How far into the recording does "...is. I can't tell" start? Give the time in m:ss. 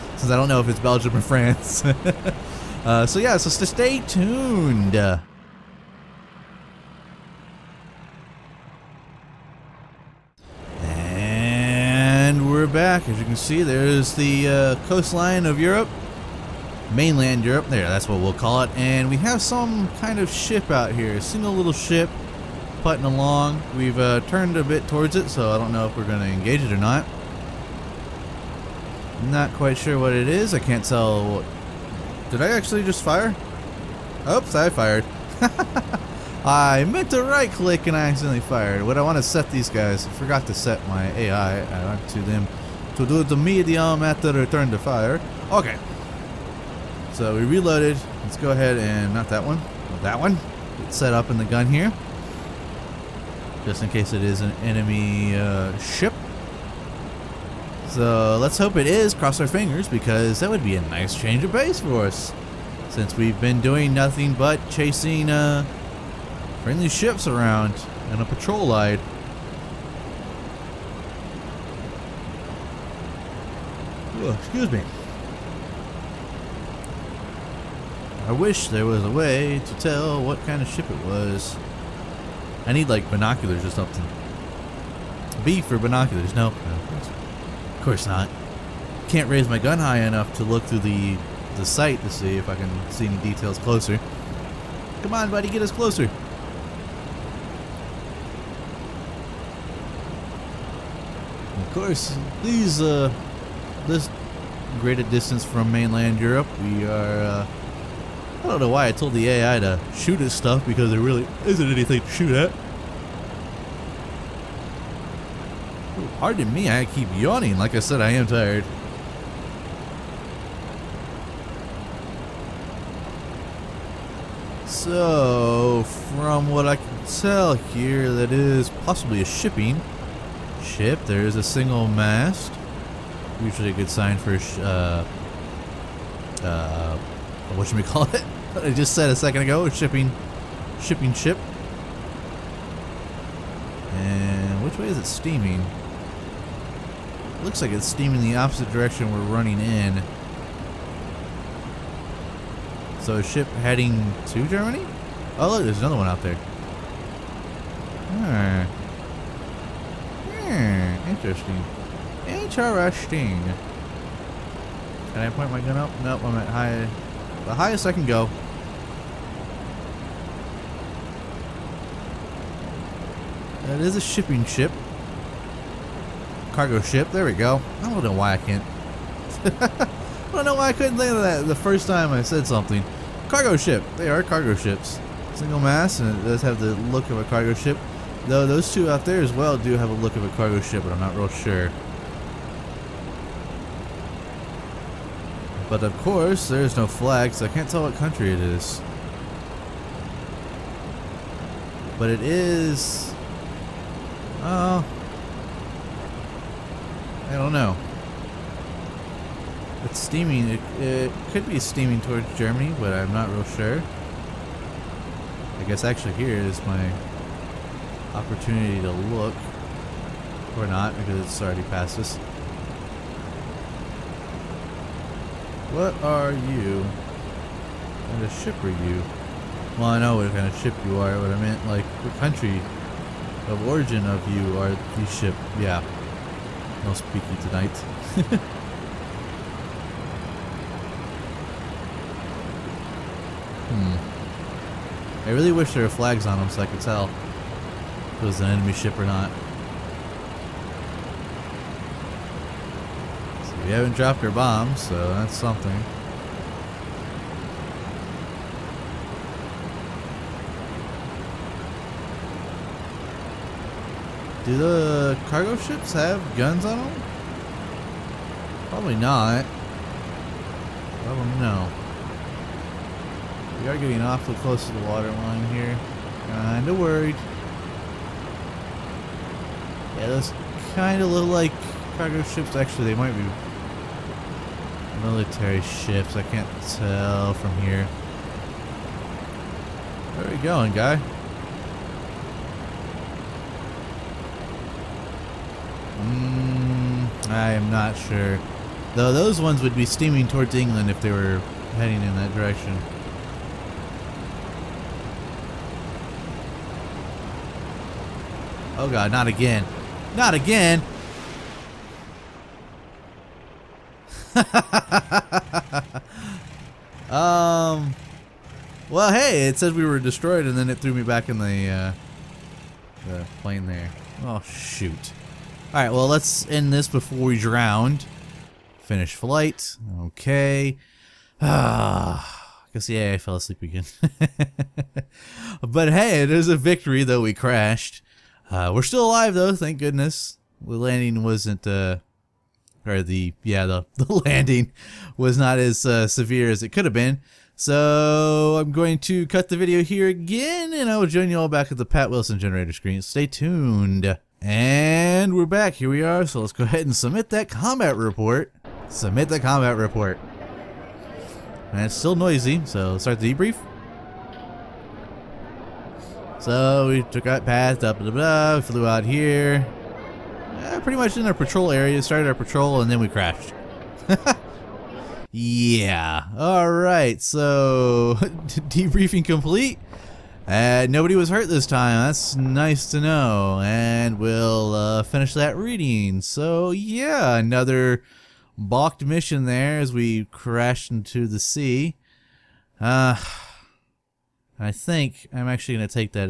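0:30.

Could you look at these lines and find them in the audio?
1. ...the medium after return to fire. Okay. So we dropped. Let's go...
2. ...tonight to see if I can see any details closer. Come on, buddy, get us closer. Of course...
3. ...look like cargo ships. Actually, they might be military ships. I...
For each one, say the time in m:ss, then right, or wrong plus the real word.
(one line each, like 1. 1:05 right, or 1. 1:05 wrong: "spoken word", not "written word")
1. 0:43 wrong: "reloaded", not "dropped"
2. 1:31 wrong: "sight", not "tonight"
3. 4:41 right.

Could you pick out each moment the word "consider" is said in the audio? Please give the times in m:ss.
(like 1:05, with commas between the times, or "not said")
not said.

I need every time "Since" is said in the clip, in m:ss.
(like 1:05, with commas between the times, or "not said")
0:00, 1:02.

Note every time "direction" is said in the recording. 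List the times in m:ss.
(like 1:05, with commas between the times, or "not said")
2:28, 5:02.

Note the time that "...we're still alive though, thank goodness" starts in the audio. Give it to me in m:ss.
5:38.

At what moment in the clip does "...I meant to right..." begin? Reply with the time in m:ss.
0:36.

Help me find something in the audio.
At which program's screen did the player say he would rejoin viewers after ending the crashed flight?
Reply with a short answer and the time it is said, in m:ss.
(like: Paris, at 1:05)
Pat Wilson generator, at 5:51.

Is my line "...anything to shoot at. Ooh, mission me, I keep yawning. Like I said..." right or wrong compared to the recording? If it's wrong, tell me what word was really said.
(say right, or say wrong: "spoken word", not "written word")
wrong: "pardon", not "mission".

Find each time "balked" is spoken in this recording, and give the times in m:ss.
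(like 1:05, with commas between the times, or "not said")
6:28.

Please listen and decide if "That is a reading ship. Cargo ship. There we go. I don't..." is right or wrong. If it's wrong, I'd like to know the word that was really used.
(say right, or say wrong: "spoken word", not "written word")
wrong: "shipping", not "reading".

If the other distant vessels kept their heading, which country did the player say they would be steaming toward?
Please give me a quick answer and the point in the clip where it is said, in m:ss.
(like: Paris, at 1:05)
England, at 5:00.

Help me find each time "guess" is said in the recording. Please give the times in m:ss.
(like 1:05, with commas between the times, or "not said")
3:35, 5:32.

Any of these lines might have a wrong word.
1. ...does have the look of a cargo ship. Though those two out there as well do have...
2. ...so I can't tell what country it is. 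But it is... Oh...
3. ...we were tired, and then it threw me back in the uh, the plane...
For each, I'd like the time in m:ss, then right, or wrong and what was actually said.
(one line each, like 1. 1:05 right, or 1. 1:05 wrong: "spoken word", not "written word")
1. 3:06 right
2. 3:17 right
3. 5:19 wrong: "destroyed", not "tired".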